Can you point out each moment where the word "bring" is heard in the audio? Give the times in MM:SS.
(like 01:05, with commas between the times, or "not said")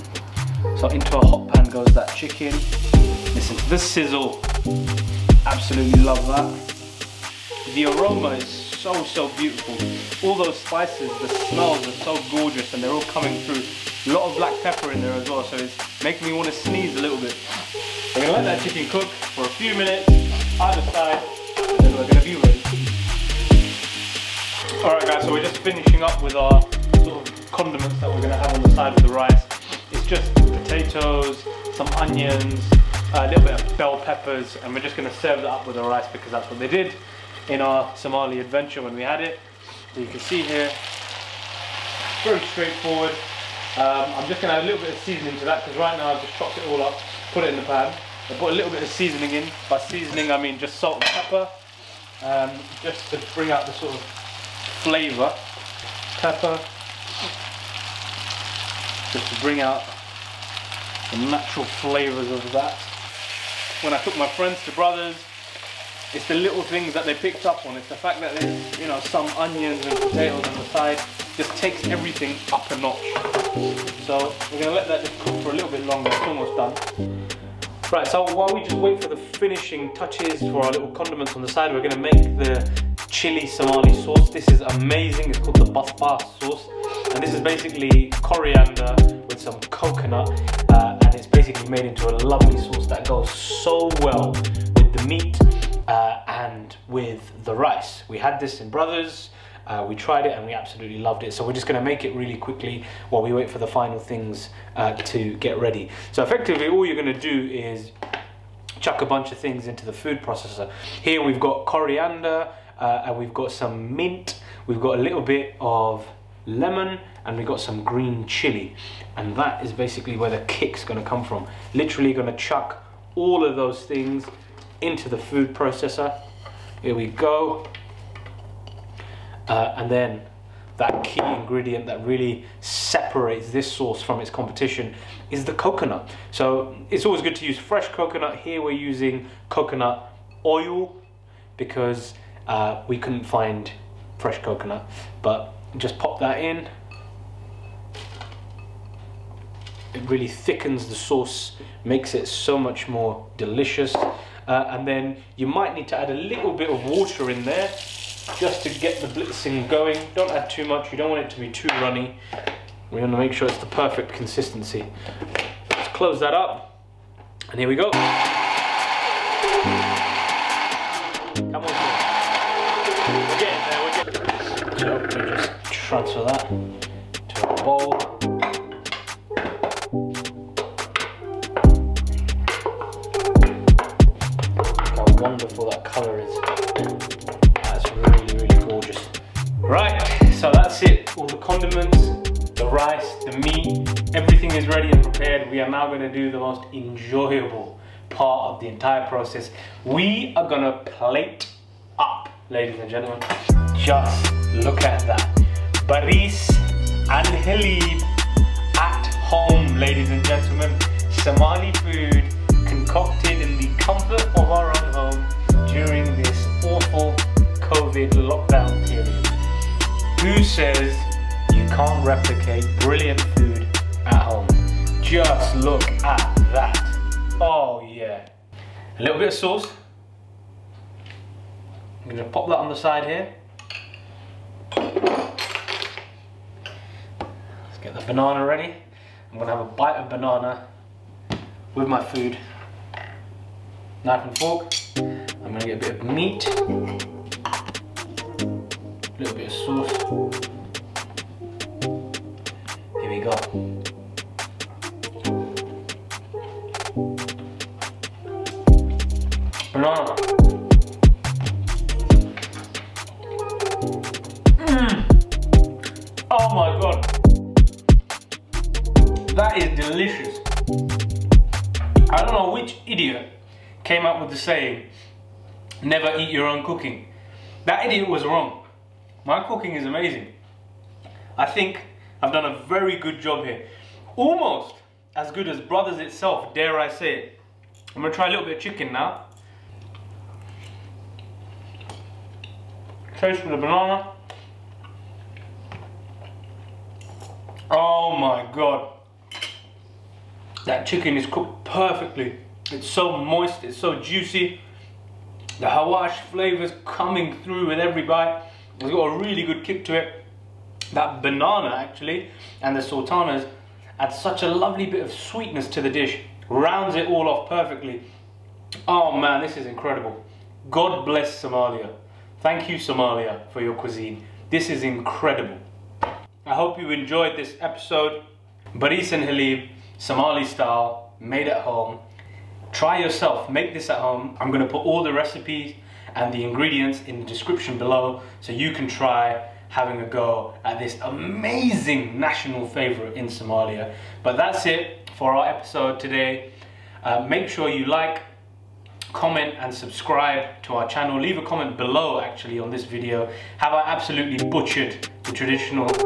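00:53, 00:59.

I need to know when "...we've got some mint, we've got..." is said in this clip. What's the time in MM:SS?
01:53.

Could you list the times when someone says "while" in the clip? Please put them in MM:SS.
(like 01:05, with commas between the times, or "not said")
01:18, 01:43.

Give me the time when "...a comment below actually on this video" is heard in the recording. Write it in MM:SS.
05:51.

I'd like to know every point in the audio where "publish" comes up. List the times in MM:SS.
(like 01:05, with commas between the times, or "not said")
not said.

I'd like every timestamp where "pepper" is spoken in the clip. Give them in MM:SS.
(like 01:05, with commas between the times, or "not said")
00:14, 00:34, 00:51, 00:56.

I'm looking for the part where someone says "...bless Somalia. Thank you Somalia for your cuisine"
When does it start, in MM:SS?
05:21.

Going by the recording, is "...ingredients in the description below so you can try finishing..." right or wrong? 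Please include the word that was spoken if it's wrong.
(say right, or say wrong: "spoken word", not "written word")
wrong: "having", not "finishing".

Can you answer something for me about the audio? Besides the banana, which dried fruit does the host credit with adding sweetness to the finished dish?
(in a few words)
sultanas.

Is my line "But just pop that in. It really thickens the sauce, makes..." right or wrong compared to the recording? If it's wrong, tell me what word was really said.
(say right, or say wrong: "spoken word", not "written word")
right.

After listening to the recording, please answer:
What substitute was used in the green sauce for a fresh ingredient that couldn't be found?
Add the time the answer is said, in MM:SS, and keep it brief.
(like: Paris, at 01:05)
coconut oil, at 02:19.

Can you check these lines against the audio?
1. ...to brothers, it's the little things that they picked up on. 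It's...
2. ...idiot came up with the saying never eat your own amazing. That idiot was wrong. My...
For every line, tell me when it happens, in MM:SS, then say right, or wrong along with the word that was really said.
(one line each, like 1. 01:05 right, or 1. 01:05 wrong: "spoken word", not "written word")
1. 01:04 right
2. 04:32 wrong: "cooking", not "amazing".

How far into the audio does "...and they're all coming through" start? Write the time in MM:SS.
00:12.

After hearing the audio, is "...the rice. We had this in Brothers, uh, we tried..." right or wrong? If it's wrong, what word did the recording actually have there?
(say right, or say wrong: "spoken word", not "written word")
right.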